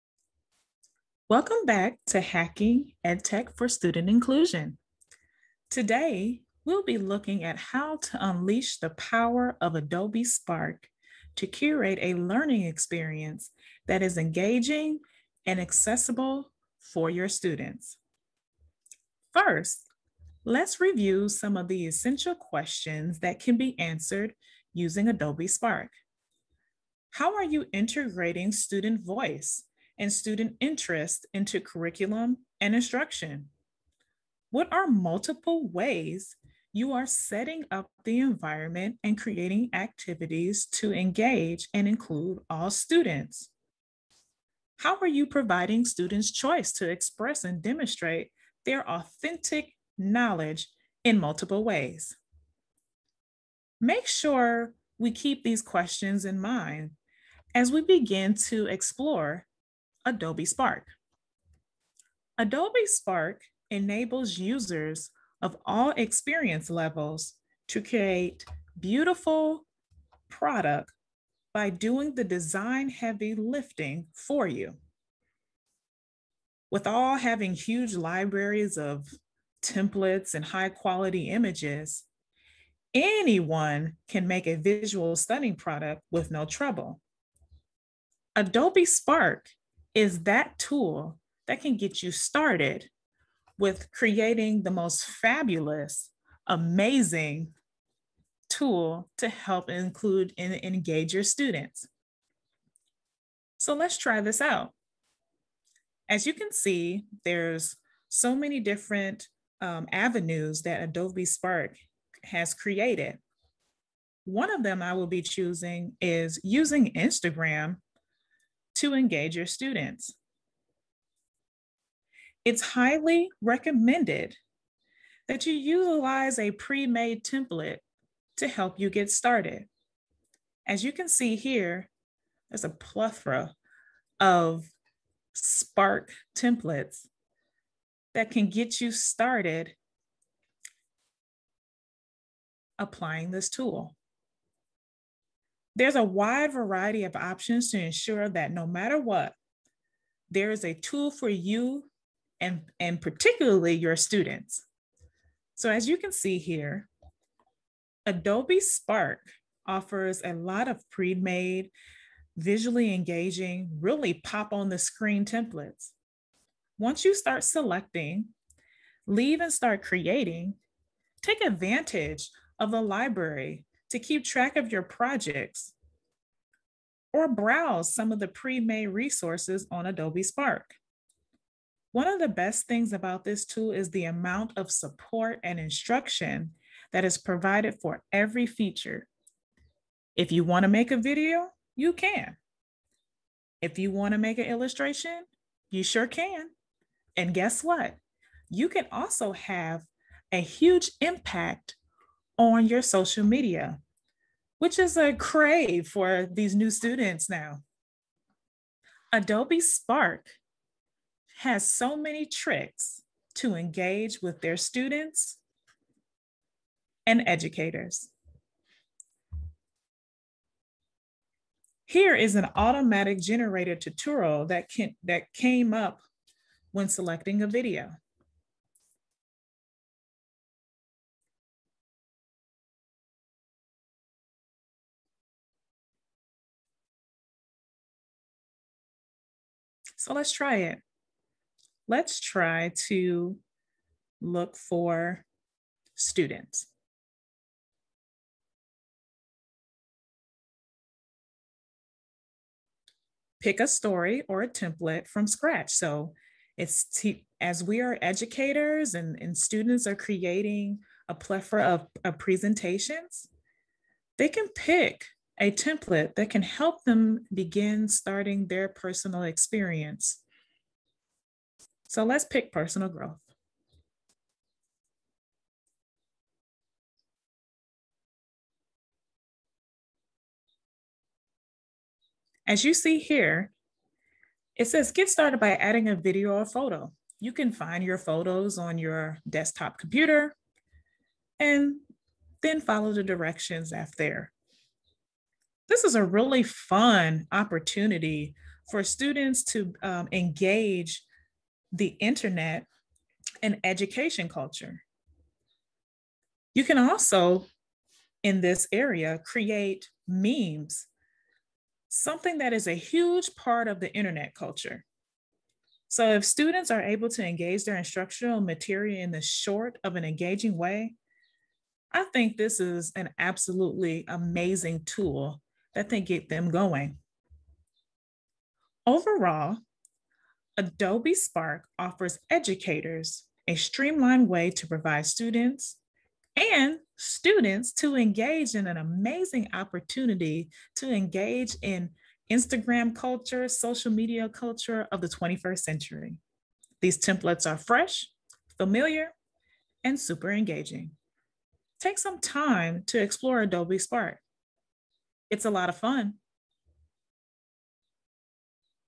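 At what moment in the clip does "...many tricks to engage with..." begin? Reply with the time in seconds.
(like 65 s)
211 s.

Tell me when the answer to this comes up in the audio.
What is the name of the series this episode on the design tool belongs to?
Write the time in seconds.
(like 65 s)
2 s.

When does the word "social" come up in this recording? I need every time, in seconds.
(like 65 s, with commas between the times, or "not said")
202 s, 343 s.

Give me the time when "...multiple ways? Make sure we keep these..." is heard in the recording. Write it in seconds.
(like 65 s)
51 s.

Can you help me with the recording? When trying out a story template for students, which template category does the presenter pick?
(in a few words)
personal growth.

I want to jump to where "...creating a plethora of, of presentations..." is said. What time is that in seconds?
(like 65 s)
259 s.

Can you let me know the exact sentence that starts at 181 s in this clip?
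One of the best things about this tool is the amount of support and instruction that is provided for every feature.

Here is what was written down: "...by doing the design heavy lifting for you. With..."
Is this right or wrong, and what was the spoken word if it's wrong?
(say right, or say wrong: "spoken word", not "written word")
right.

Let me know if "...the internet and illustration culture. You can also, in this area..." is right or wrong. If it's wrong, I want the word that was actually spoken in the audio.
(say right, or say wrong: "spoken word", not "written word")
wrong: "education", not "illustration".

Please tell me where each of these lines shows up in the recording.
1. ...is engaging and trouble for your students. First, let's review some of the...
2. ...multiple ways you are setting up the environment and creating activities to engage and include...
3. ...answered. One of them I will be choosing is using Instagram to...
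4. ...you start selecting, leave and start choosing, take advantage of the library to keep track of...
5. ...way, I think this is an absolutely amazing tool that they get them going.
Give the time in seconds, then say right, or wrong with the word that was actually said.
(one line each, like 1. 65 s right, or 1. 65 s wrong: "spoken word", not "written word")
1. 14 s wrong: "accessible", not "trouble"
2. 34 s right
3. 112 s wrong: "created", not "answered"
4. 167 s wrong: "creating", not "choosing"
5. 320 s right.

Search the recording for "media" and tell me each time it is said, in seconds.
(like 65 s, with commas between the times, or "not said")
203 s, 343 s.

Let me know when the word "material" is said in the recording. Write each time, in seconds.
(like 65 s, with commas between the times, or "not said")
318 s.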